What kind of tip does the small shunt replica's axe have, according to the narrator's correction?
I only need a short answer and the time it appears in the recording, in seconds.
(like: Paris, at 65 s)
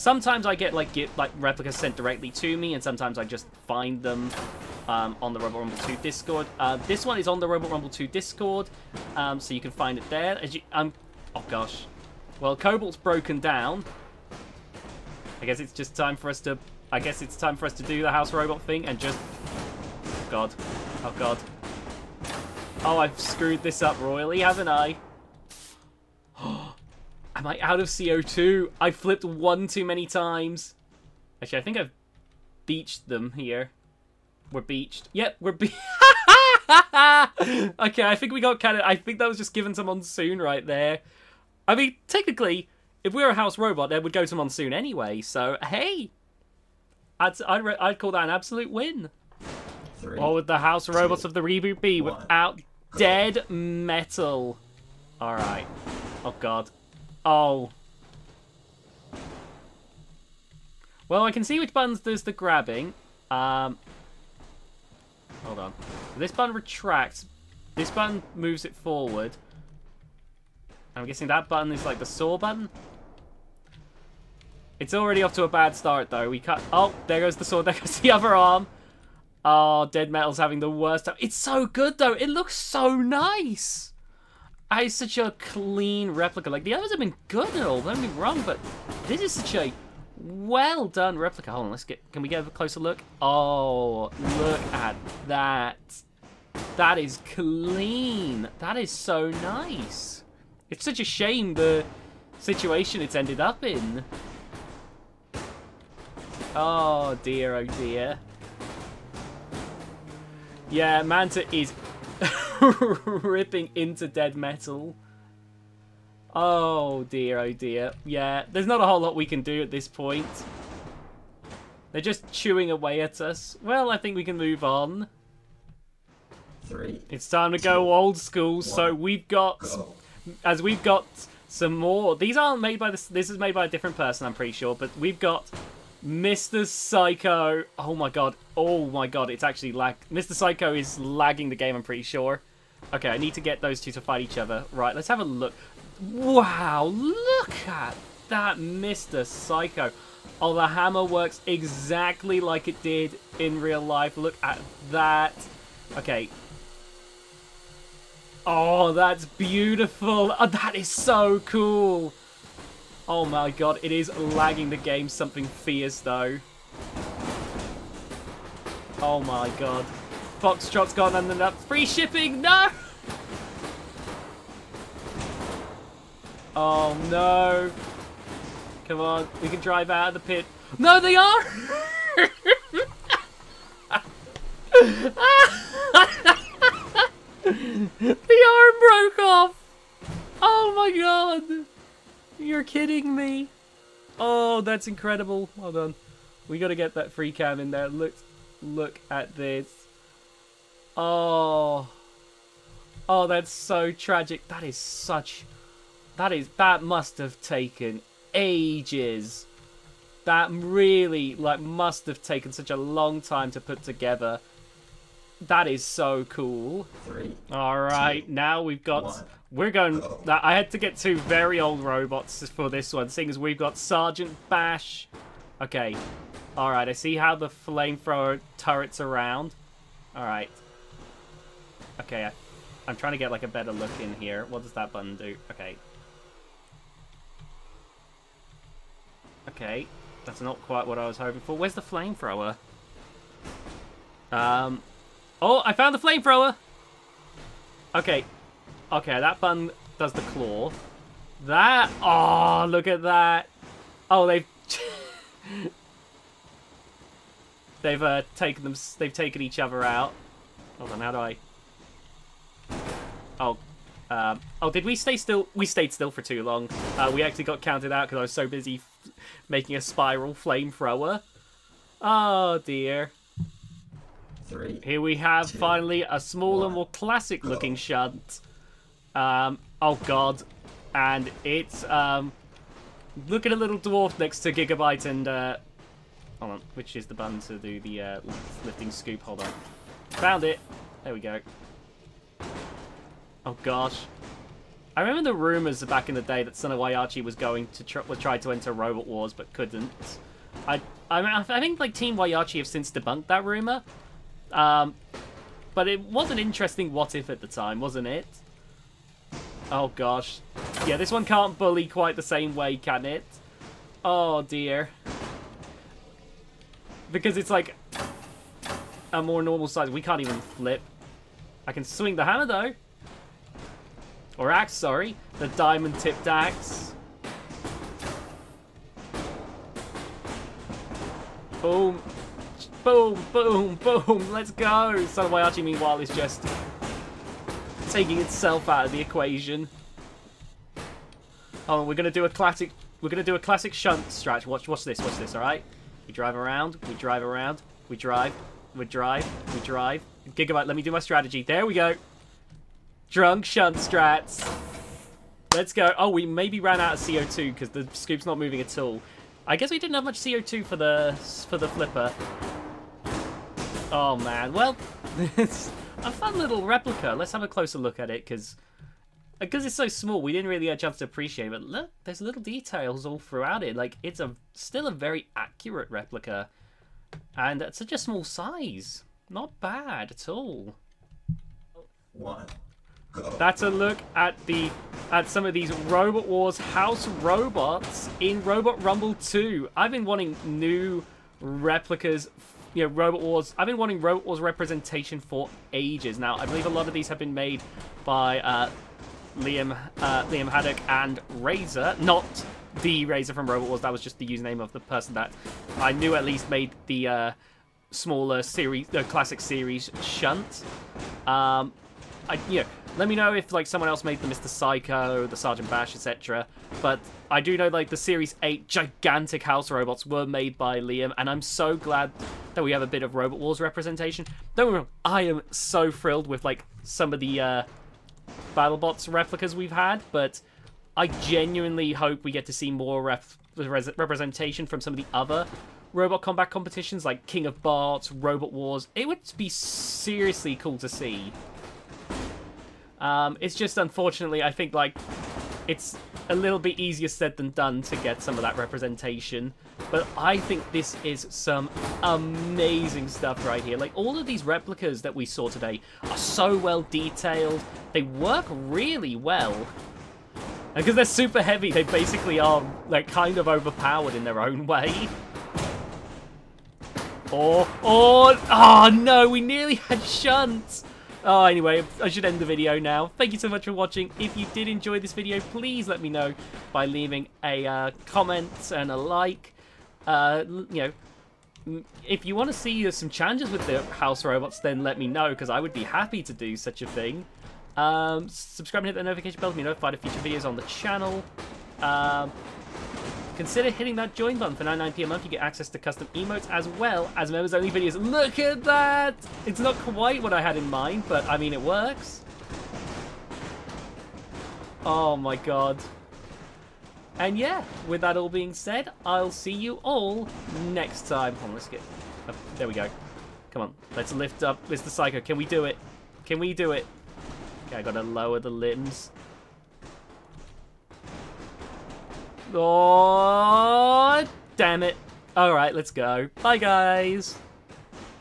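Diamond tipped, at 325 s.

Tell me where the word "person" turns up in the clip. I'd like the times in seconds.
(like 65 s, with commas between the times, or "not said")
133 s, 404 s.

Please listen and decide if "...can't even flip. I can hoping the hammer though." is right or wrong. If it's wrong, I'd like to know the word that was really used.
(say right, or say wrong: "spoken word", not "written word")
wrong: "swing", not "hoping".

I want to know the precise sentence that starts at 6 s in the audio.
Uh, this one is on the Robot Rumble 2 Discord, um, so you can find it there.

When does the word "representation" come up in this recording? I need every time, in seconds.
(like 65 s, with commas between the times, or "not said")
394 s, 423 s, 433 s, 448 s.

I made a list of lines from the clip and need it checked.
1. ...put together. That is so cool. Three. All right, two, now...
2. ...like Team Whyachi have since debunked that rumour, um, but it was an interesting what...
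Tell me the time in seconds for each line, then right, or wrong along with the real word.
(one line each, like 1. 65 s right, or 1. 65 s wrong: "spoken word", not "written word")
1. 213 s right
2. 301 s right.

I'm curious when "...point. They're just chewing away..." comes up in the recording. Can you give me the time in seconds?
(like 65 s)
119 s.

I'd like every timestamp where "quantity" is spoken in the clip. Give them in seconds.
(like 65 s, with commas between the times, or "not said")
not said.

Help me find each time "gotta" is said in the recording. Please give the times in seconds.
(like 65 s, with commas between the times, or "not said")
196 s, 517 s.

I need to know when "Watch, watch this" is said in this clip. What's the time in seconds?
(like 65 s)
344 s.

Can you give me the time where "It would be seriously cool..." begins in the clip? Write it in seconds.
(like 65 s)
438 s.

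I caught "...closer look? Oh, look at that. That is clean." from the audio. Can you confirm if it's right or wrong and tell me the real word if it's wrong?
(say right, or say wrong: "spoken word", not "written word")
right.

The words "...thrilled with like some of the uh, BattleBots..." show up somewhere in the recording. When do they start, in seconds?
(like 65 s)
425 s.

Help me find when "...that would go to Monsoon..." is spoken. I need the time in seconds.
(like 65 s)
43 s.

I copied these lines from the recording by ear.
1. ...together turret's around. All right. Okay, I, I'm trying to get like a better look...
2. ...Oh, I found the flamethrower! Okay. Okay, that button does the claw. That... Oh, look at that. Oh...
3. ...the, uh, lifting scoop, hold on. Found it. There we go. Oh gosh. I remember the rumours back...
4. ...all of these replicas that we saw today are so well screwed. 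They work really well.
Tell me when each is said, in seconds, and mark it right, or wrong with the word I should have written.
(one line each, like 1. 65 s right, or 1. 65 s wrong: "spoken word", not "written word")
1. 227 s wrong: "flamethrower", not "together"
2. 245 s right
3. 287 s right
4. 453 s wrong: "detailed", not "screwed".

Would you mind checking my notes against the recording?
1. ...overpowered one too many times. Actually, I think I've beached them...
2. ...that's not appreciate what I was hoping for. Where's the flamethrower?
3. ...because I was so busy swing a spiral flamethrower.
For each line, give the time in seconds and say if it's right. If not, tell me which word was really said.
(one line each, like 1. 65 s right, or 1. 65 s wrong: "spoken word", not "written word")
1. 28 s wrong: "flipped", not "overpowered"
2. 240 s wrong: "quite", not "appreciate"
3. 268 s wrong: "making", not "swing".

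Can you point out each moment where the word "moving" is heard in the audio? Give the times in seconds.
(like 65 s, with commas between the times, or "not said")
358 s.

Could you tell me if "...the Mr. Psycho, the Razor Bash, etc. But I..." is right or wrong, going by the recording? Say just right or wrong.
wrong.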